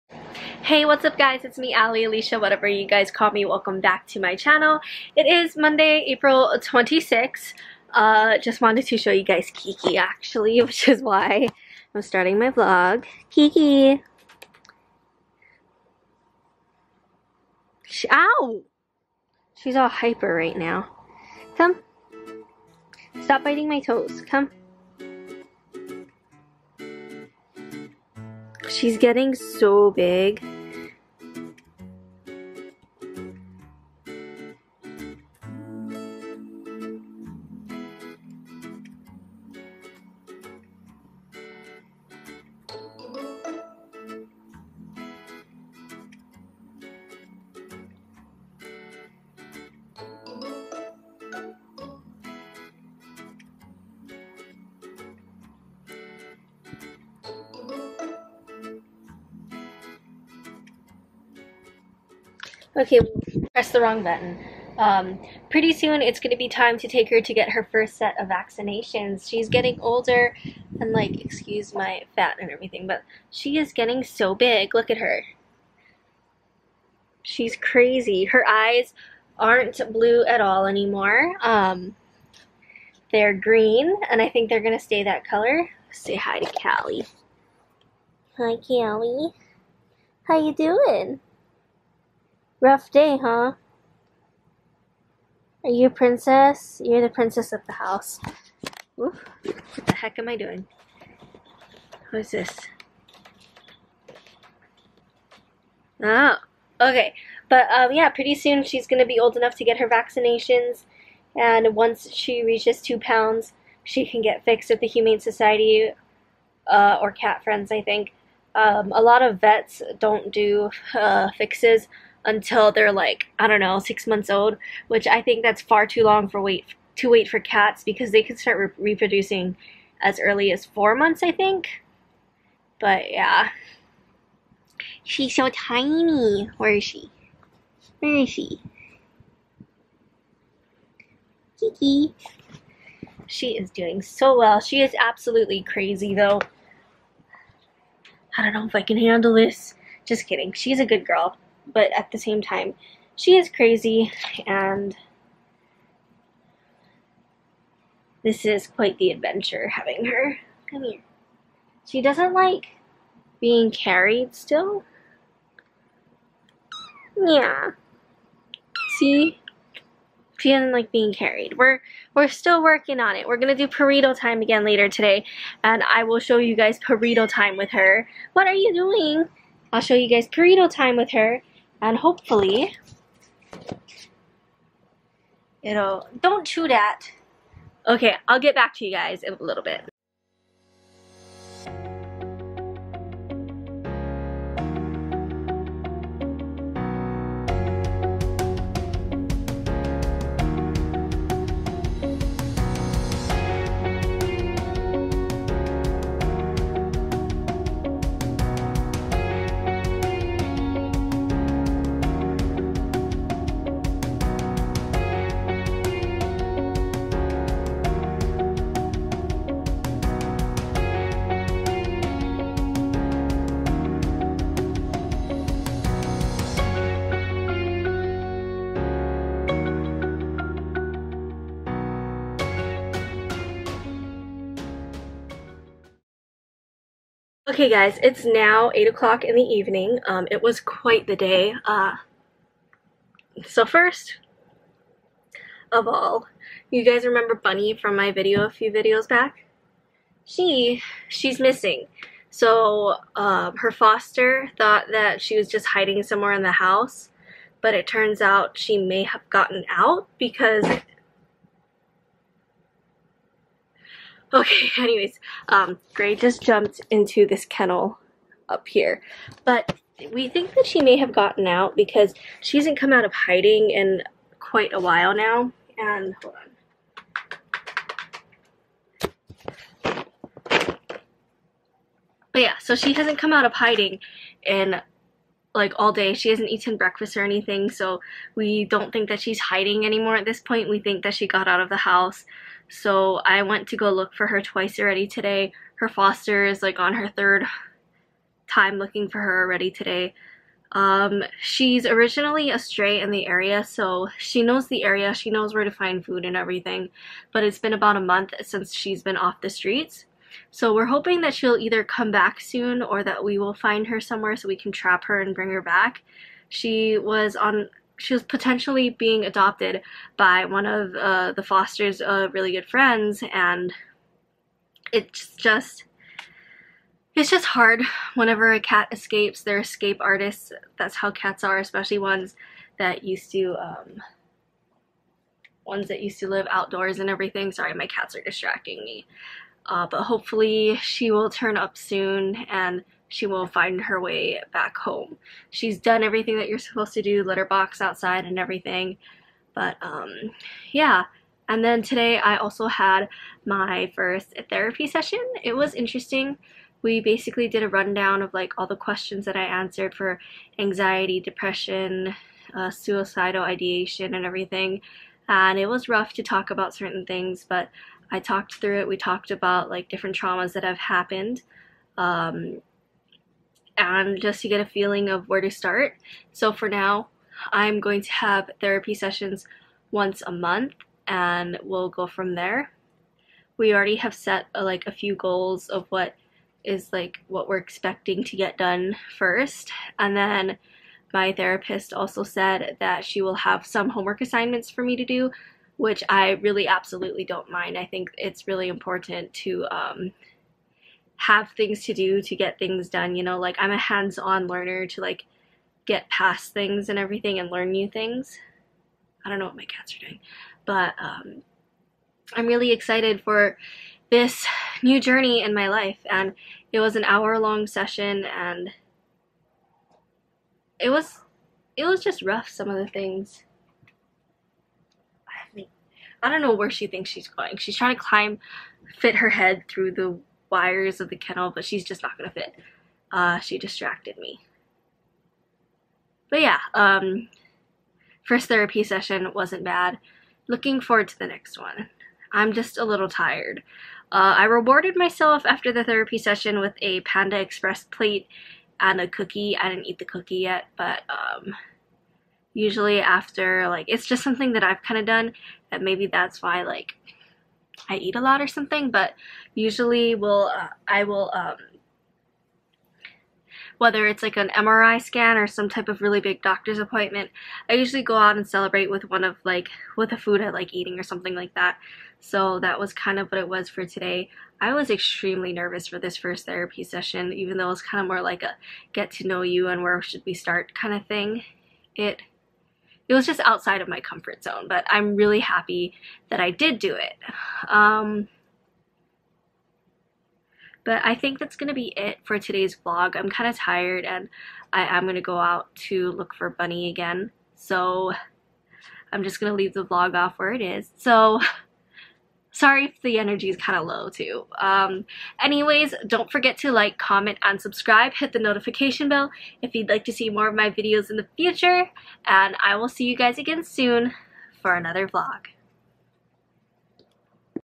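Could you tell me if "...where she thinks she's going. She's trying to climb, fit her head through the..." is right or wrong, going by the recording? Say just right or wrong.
right.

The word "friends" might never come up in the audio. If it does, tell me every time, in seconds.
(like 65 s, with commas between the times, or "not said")
117 s, 322 s.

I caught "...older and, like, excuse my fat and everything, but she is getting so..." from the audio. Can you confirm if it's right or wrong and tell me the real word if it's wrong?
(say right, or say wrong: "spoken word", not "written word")
right.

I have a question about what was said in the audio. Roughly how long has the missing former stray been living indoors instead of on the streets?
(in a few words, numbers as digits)
About a month.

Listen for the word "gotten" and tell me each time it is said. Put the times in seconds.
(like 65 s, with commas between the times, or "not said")
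259 s, 271 s.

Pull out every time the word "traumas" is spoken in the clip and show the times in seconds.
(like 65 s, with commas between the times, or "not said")
370 s.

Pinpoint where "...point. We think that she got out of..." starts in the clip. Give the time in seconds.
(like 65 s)
290 s.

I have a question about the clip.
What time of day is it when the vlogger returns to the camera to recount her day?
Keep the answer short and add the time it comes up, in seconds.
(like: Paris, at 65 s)
8 o'clock, at 238 s.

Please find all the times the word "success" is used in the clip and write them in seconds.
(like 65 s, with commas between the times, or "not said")
not said.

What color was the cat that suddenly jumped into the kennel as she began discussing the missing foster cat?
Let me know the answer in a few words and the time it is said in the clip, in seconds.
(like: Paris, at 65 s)
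Gray, at 265 s.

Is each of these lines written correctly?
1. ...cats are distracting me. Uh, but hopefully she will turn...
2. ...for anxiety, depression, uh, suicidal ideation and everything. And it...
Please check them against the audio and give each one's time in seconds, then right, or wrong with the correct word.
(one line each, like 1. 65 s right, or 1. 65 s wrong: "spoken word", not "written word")
1. 337 s right
2. 359 s right.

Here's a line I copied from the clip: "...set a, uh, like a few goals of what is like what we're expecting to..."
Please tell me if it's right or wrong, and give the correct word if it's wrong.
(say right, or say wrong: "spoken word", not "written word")
right.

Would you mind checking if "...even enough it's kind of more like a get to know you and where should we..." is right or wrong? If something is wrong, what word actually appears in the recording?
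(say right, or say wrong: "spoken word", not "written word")
wrong: "though", not "enough".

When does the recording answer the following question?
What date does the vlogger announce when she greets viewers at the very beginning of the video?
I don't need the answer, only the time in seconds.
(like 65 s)
6 s.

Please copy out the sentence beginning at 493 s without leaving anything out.
I'm kind of tired and I am going to go out to look for Bunny again.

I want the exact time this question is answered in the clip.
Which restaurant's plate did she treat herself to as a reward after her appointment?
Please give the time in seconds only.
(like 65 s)
447 s.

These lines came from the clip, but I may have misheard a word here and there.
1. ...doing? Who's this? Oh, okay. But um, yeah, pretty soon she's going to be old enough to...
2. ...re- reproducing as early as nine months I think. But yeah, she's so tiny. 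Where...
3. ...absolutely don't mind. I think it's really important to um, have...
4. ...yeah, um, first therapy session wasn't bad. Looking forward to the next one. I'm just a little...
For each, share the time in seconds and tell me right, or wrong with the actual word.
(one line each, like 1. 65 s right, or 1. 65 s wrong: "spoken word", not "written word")
1. 100 s right
2. 128 s wrong: "four", not "nine"
3. 396 s right
4. 436 s right.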